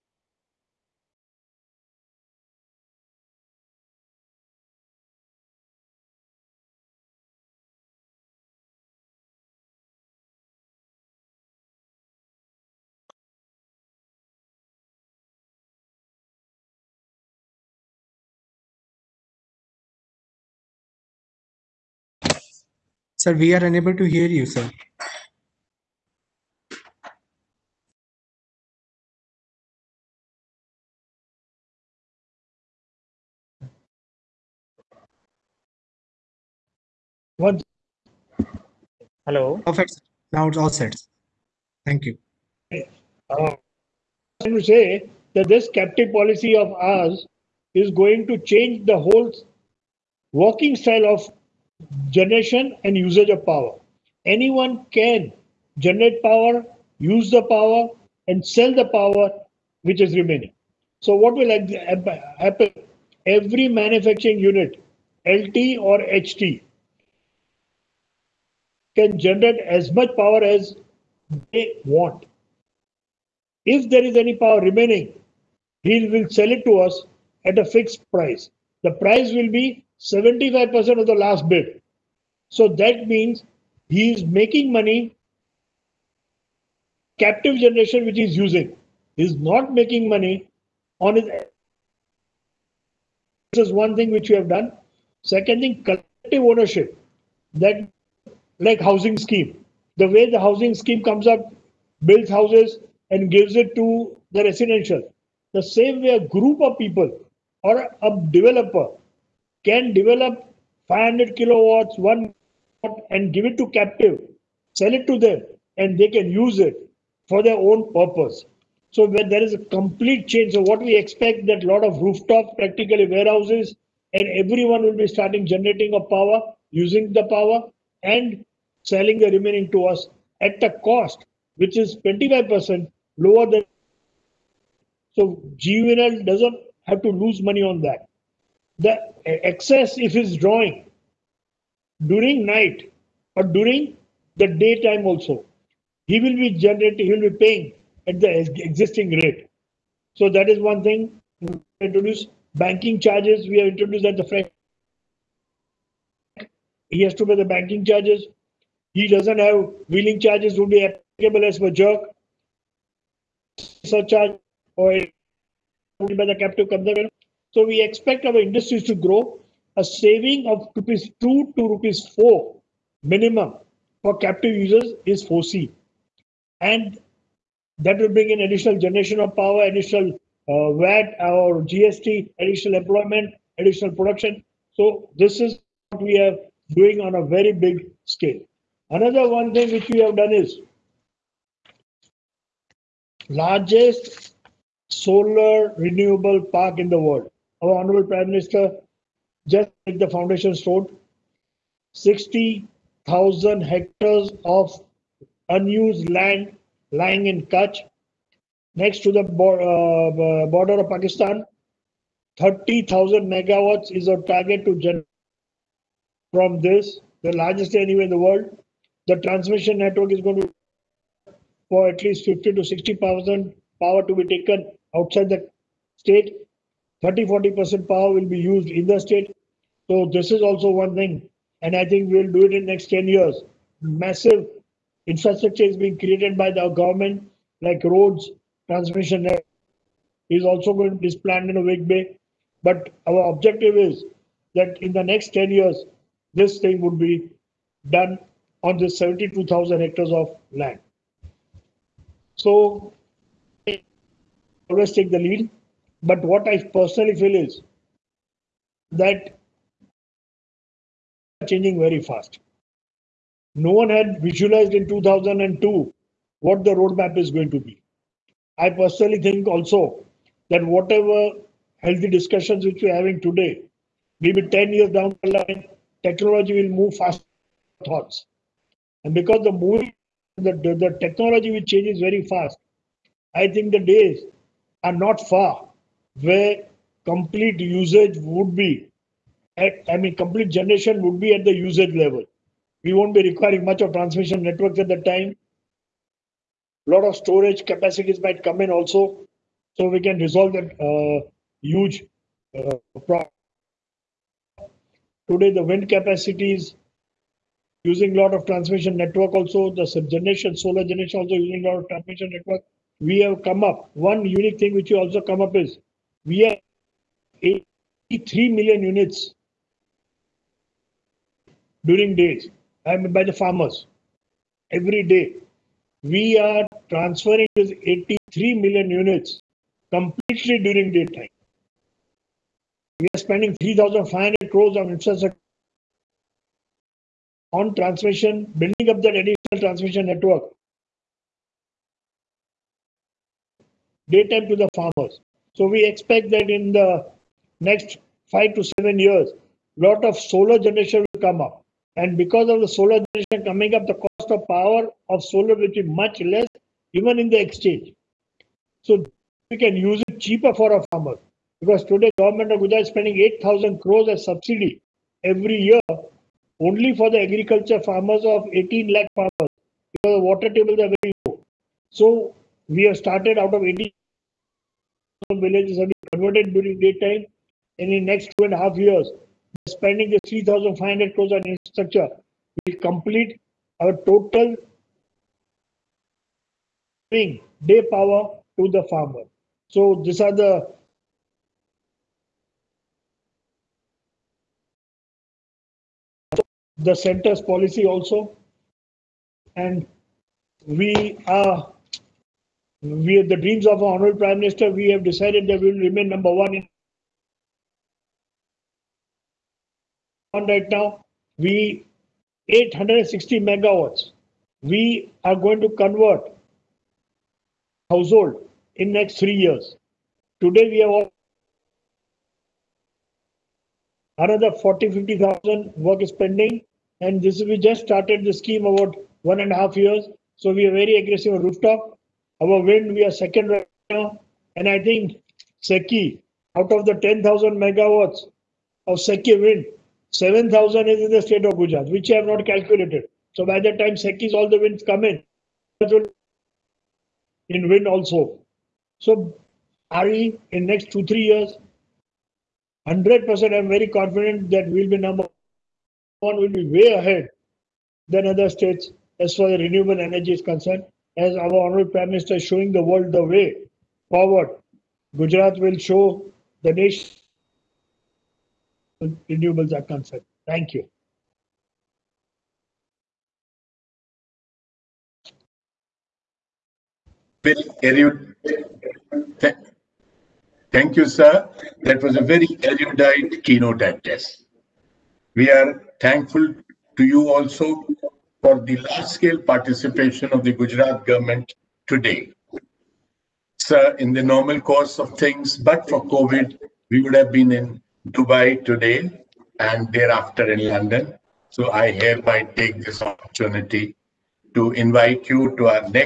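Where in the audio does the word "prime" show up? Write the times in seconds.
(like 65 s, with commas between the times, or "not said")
198 s, 404 s, 461 s.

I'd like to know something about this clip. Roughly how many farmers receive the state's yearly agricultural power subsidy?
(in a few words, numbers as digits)
18 lakh.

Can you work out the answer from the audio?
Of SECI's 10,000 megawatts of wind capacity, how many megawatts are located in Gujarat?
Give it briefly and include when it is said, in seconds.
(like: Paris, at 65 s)
7,000, at 440 s.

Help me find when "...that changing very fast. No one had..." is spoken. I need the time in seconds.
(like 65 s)
258 s.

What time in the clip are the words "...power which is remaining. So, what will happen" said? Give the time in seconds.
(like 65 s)
58 s.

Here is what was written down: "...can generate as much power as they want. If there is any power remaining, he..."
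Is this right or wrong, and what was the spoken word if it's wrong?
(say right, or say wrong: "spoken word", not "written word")
right.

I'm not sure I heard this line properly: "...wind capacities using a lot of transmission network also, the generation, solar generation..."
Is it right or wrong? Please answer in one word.
right.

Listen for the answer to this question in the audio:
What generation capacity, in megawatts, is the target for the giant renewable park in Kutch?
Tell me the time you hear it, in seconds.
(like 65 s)
212 s.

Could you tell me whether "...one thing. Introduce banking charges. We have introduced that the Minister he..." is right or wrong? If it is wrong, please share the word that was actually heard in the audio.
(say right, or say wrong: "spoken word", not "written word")
wrong: "French", not "Minister".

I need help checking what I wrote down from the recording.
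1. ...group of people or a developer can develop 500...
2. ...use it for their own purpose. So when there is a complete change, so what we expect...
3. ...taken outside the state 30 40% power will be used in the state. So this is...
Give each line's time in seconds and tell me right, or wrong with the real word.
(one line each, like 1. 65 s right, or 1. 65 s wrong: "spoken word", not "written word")
1. 106 s right
2. 116 s right
3. 224 s right.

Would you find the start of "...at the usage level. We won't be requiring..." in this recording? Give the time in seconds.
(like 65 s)
291 s.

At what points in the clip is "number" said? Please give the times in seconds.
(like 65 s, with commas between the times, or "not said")
406 s, 454 s.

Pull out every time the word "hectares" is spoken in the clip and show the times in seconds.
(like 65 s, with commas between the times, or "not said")
203 s, 249 s.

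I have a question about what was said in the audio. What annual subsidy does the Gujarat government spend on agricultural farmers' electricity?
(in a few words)
8,000 crores.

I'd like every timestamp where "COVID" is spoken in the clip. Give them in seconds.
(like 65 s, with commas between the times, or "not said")
496 s.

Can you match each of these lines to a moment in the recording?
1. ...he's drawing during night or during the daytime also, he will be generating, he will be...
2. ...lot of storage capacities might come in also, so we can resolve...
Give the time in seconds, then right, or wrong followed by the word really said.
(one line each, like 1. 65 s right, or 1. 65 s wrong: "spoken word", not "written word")
1. 140 s right
2. 296 s right.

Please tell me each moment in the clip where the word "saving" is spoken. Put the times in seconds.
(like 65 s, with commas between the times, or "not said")
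169 s.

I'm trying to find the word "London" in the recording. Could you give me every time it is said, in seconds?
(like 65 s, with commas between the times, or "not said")
500 s.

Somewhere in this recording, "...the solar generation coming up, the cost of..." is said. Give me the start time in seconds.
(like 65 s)
352 s.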